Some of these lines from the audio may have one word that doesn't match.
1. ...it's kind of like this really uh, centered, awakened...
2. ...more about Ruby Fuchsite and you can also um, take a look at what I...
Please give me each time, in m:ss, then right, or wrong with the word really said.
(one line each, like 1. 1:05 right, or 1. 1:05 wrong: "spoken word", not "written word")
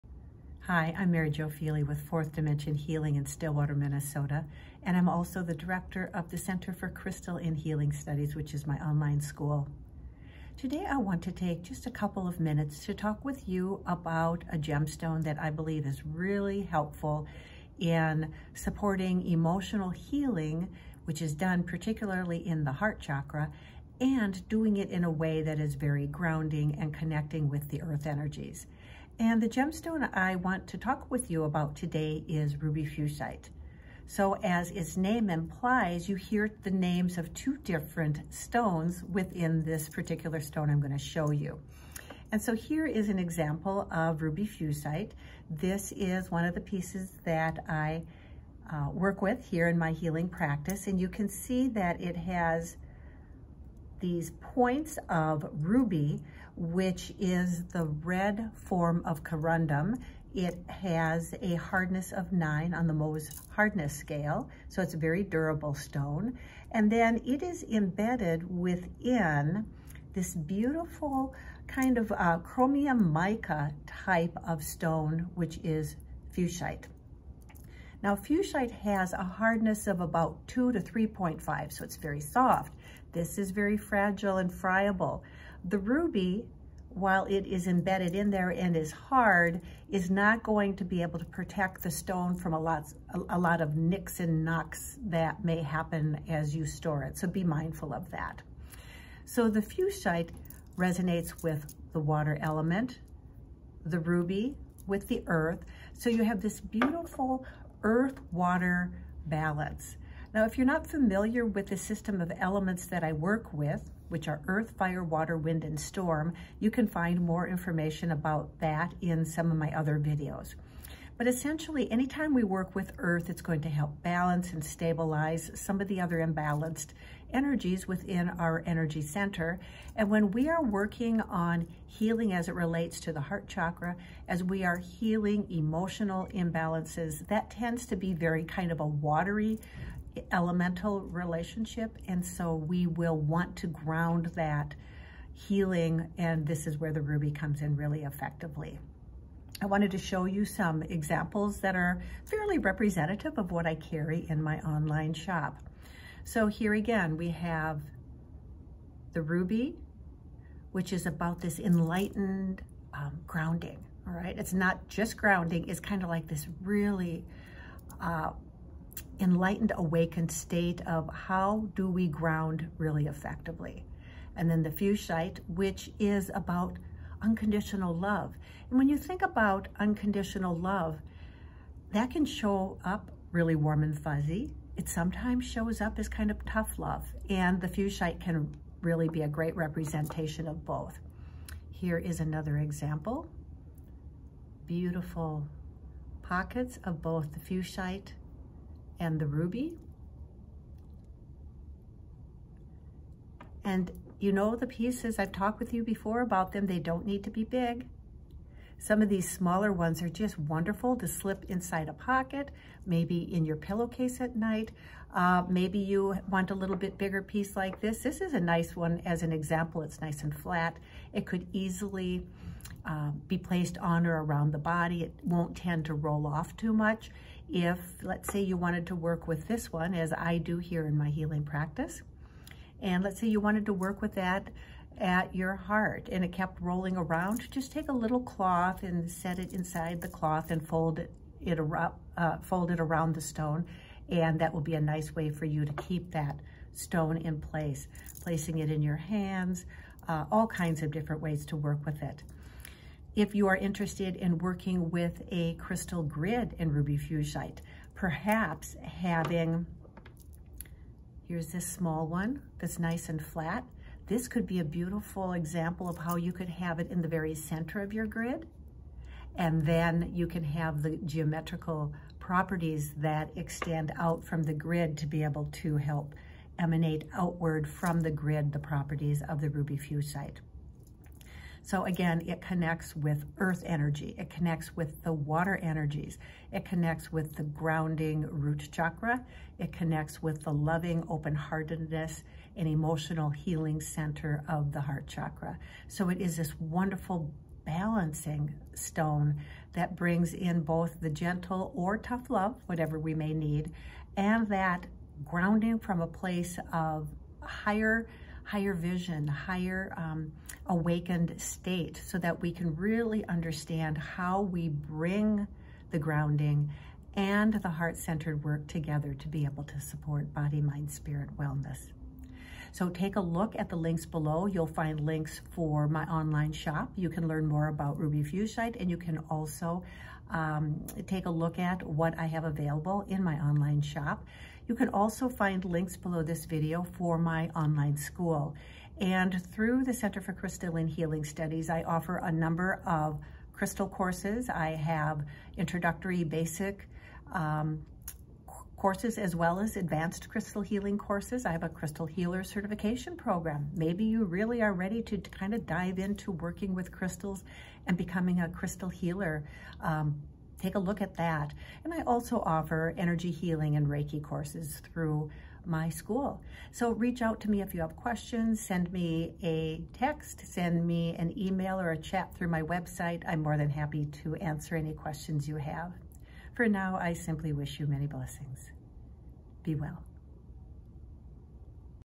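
1. 2:45 wrong: "enlightened", not "centered"
2. 5:27 right.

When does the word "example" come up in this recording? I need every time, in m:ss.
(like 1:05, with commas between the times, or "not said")
0:43, 2:30, 3:12, 3:39, 4:25.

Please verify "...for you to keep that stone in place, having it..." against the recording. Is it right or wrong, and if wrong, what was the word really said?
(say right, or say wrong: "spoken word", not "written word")
wrong: "placing", not "having".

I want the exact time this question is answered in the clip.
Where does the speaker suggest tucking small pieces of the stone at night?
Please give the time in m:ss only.
3:33.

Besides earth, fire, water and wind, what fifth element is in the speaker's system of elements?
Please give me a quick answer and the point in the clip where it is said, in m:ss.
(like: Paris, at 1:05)
storm, at 1:55.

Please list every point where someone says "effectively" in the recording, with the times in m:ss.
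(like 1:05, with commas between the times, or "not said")
2:28, 2:53.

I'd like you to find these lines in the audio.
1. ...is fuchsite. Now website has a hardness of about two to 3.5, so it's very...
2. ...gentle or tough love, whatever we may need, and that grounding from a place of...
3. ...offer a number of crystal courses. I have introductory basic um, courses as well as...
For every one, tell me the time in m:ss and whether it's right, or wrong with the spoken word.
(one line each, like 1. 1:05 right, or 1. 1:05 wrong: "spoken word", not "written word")
1. 1:15 wrong: "fuchsite", not "website"
2. 5:01 right
3. 5:41 right.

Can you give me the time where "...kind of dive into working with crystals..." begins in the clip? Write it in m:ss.
5:55.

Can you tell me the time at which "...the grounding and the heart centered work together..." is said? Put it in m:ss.
5:15.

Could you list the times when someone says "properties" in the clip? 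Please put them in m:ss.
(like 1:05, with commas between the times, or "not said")
4:32, 4:38.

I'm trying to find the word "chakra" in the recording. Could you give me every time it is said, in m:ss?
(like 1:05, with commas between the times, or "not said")
0:22, 2:13, 4:48, 4:55.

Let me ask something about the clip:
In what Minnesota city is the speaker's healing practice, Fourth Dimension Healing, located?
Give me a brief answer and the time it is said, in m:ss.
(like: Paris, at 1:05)
Stillwater, at 0:03.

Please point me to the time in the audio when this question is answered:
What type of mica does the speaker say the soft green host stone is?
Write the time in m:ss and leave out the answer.
1:12.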